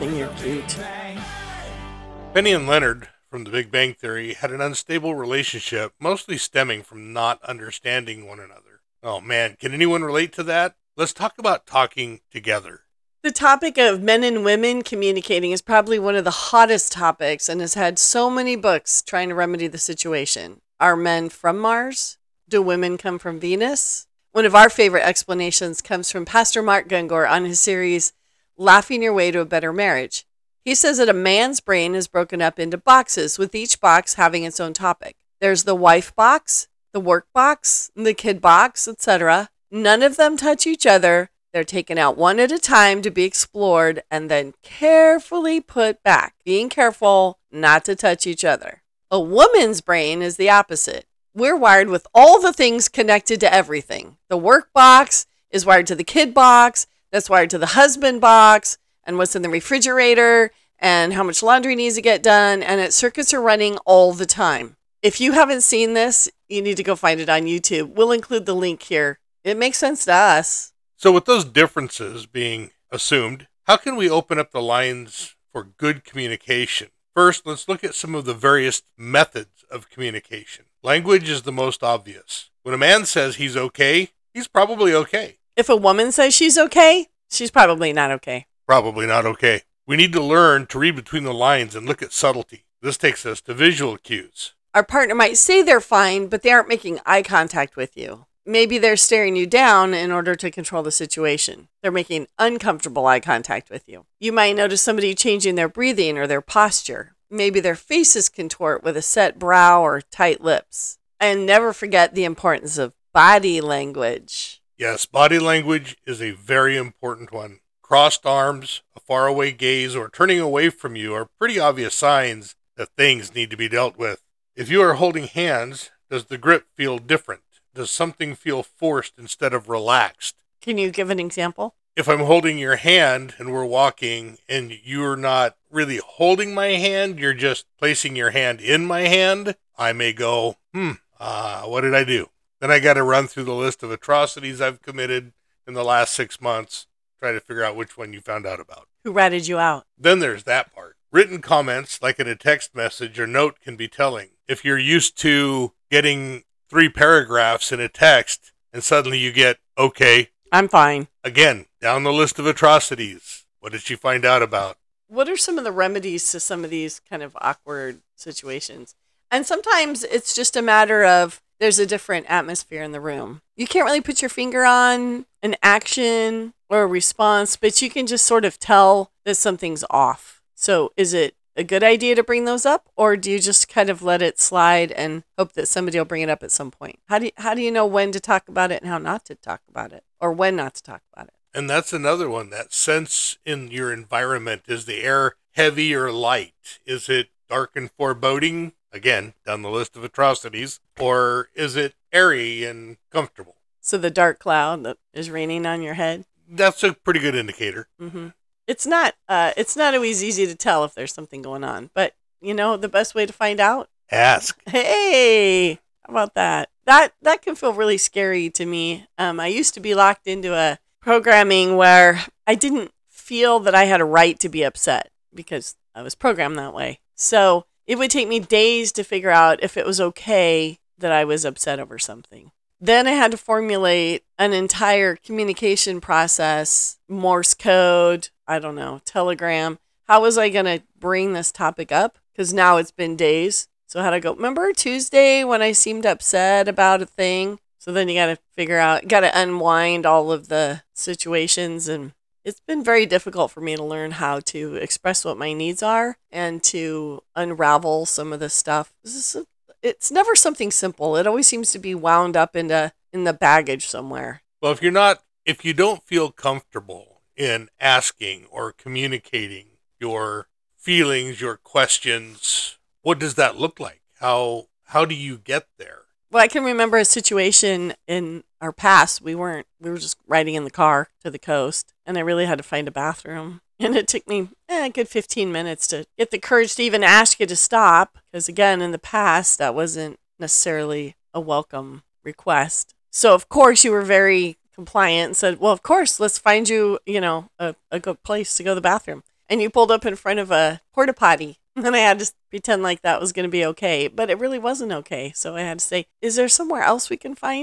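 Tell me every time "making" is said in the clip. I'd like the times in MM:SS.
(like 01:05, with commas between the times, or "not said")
01:36, 01:41.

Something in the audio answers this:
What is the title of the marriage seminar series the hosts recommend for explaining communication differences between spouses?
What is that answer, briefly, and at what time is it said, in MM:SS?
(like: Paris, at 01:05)
Laughing Your Way to a Better Marriage, at 00:28.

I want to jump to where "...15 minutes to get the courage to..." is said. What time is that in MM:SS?
04:45.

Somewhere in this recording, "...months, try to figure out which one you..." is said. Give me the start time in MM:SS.
02:26.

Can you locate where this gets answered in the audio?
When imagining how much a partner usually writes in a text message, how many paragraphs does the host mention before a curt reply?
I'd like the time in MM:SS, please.
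02:36.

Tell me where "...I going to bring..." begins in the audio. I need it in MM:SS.
04:00.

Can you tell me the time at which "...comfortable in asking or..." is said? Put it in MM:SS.
04:26.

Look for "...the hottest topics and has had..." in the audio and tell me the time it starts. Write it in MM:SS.
00:16.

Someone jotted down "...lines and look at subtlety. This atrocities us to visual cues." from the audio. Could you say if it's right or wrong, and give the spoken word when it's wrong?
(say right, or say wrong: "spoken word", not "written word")
wrong: "takes", not "atrocities".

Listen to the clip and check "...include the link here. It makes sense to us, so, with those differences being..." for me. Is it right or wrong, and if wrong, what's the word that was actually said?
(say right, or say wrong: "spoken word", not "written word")
right.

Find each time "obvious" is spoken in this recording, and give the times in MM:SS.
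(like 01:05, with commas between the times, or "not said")
01:21, 02:01.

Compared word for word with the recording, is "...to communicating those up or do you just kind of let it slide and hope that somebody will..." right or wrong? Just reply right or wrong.
wrong.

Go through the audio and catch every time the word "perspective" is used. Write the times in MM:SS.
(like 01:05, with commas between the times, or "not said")
not said.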